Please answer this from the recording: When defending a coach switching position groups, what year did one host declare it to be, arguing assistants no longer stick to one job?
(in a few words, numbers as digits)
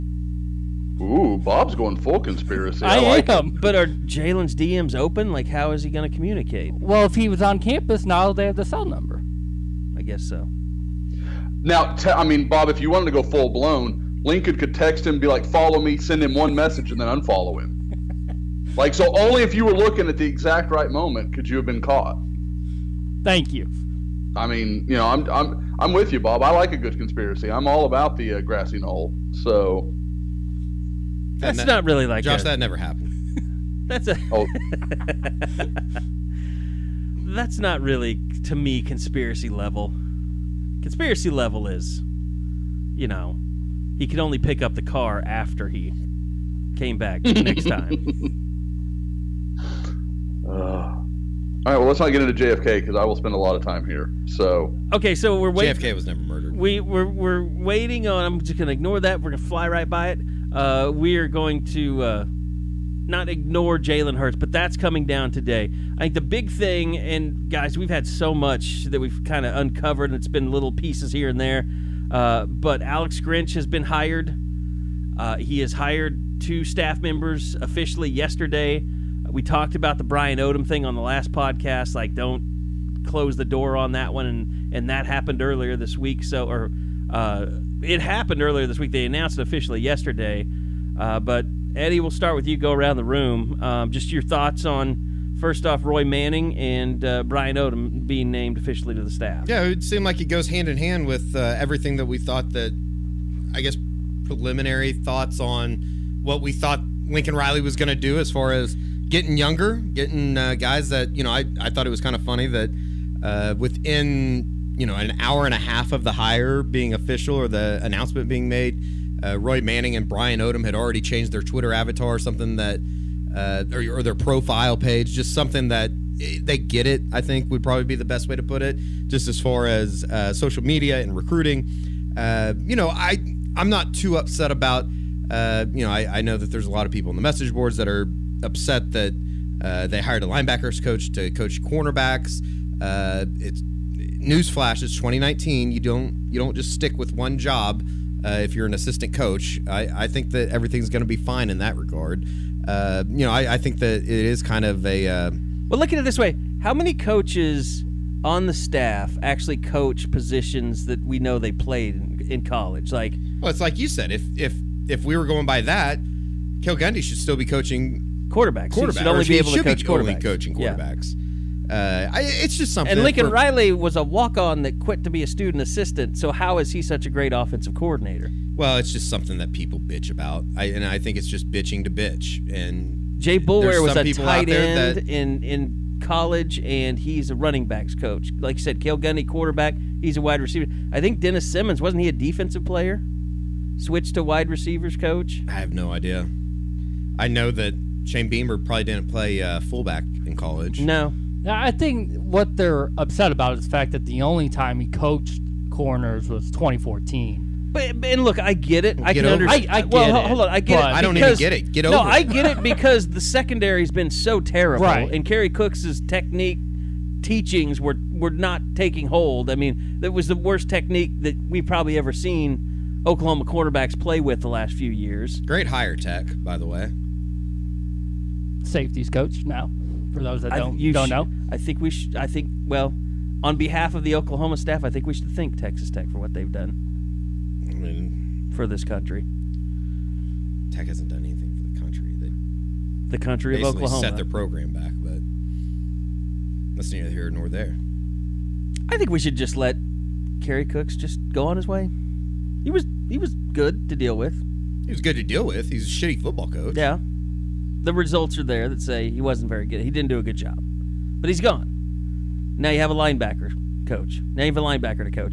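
2019.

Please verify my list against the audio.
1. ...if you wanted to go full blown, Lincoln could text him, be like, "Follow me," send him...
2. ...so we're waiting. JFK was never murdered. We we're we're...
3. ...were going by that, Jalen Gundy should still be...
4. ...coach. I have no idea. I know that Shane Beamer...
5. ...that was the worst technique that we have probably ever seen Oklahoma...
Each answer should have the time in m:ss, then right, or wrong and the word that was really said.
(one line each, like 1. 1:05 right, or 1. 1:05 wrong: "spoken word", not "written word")
1. 0:12 right
2. 0:55 right
3. 2:45 wrong: "Cale", not "Jalen"
4. 3:14 right
5. 3:39 right.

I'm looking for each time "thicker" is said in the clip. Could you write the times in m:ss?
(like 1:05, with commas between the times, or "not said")
not said.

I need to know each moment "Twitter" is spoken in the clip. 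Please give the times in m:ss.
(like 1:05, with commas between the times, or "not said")
2:01.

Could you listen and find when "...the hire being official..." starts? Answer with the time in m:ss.
1:56.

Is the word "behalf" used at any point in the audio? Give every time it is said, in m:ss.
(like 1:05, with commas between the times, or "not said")
3:53.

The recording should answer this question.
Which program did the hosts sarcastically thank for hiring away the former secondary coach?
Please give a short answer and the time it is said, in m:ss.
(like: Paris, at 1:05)
Texas Tech, at 3:55.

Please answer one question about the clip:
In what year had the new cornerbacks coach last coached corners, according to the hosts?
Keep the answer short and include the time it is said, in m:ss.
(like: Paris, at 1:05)
2014, at 3:26.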